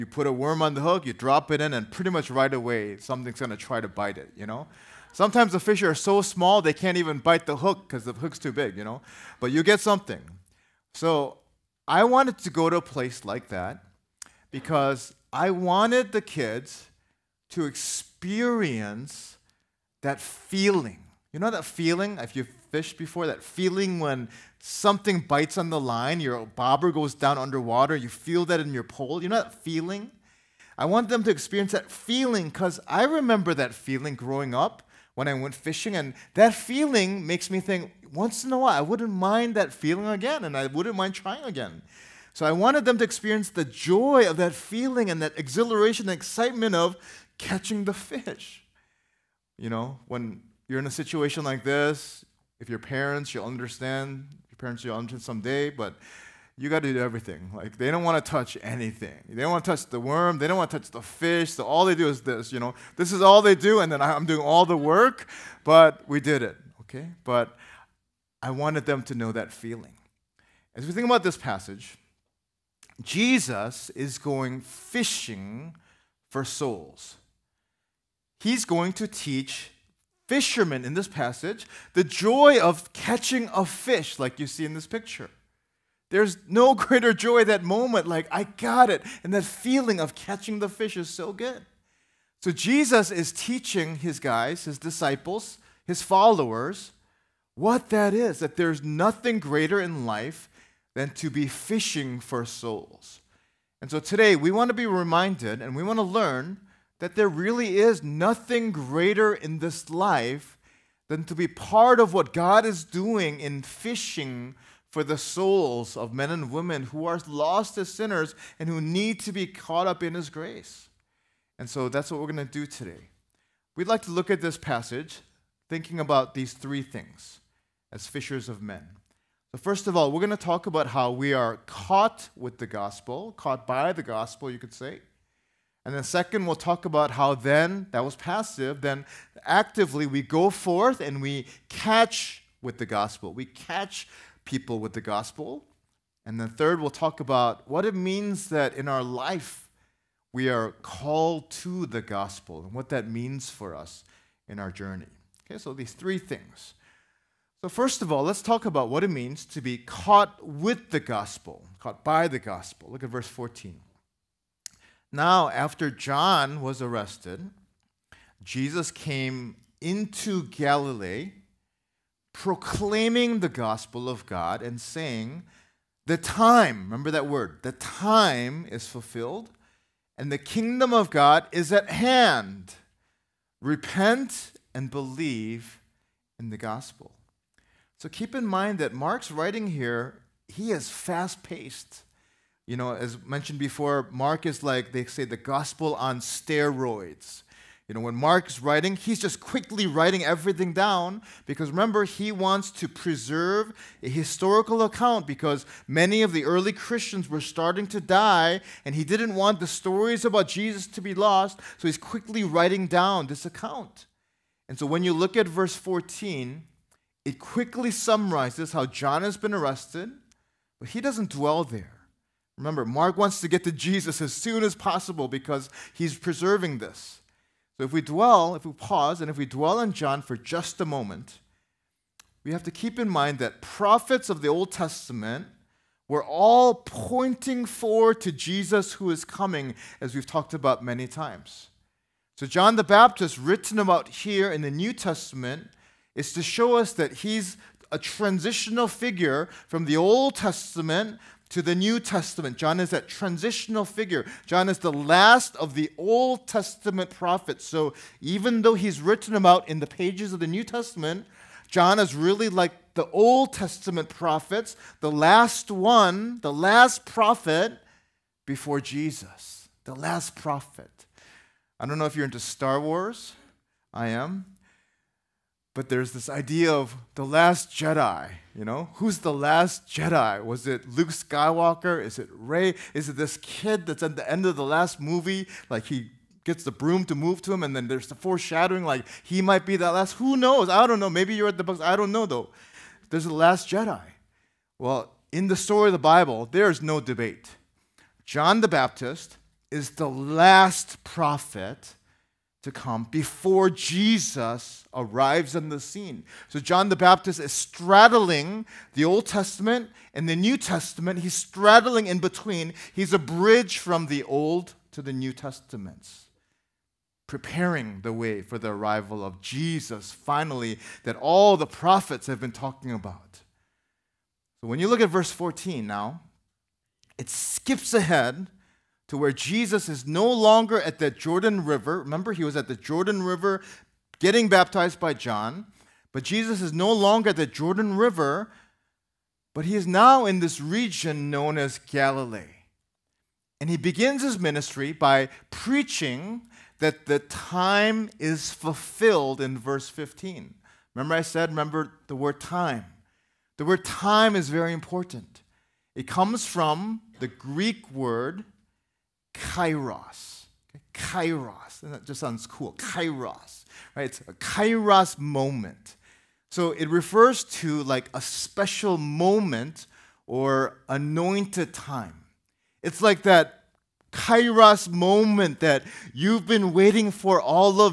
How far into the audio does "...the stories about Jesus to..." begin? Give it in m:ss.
3:29.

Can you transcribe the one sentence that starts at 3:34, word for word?
And so when you look at verse 14, it quickly summarizes how John has been arrested, but he doesn't dwell there.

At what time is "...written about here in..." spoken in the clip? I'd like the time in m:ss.
4:03.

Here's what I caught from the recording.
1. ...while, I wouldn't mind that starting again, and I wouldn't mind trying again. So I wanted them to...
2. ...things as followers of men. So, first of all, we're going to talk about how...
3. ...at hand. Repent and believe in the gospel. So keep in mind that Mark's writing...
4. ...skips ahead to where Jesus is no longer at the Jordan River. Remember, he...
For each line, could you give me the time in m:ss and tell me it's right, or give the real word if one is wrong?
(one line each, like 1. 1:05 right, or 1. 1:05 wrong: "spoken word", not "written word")
1. 0:38 wrong: "feeling", not "starting"
2. 2:06 wrong: "fishers", not "followers"
3. 3:01 right
4. 5:27 right.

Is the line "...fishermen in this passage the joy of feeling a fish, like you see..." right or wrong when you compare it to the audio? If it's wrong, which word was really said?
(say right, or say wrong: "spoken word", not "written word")
wrong: "catching", not "feeling".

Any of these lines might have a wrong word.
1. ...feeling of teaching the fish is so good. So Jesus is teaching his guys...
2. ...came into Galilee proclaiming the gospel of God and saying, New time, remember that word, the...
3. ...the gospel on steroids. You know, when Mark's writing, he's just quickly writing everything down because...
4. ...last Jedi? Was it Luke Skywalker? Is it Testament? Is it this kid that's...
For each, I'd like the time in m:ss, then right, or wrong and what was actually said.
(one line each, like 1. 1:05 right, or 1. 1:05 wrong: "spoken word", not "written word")
1. 1:29 wrong: "catching", not "teaching"
2. 2:48 wrong: "The", not "New"
3. 3:15 right
4. 4:39 wrong: "Rey", not "Testament".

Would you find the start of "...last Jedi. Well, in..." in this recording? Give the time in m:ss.
4:53.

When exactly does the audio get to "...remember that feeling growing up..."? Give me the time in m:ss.
0:33.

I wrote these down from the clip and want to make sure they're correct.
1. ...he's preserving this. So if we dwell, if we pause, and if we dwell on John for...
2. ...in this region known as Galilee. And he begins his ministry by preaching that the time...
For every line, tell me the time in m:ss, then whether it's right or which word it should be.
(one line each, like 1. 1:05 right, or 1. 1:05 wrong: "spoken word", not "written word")
1. 3:45 right
2. 5:40 right.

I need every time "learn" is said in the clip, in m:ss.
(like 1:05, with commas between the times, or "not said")
1:46.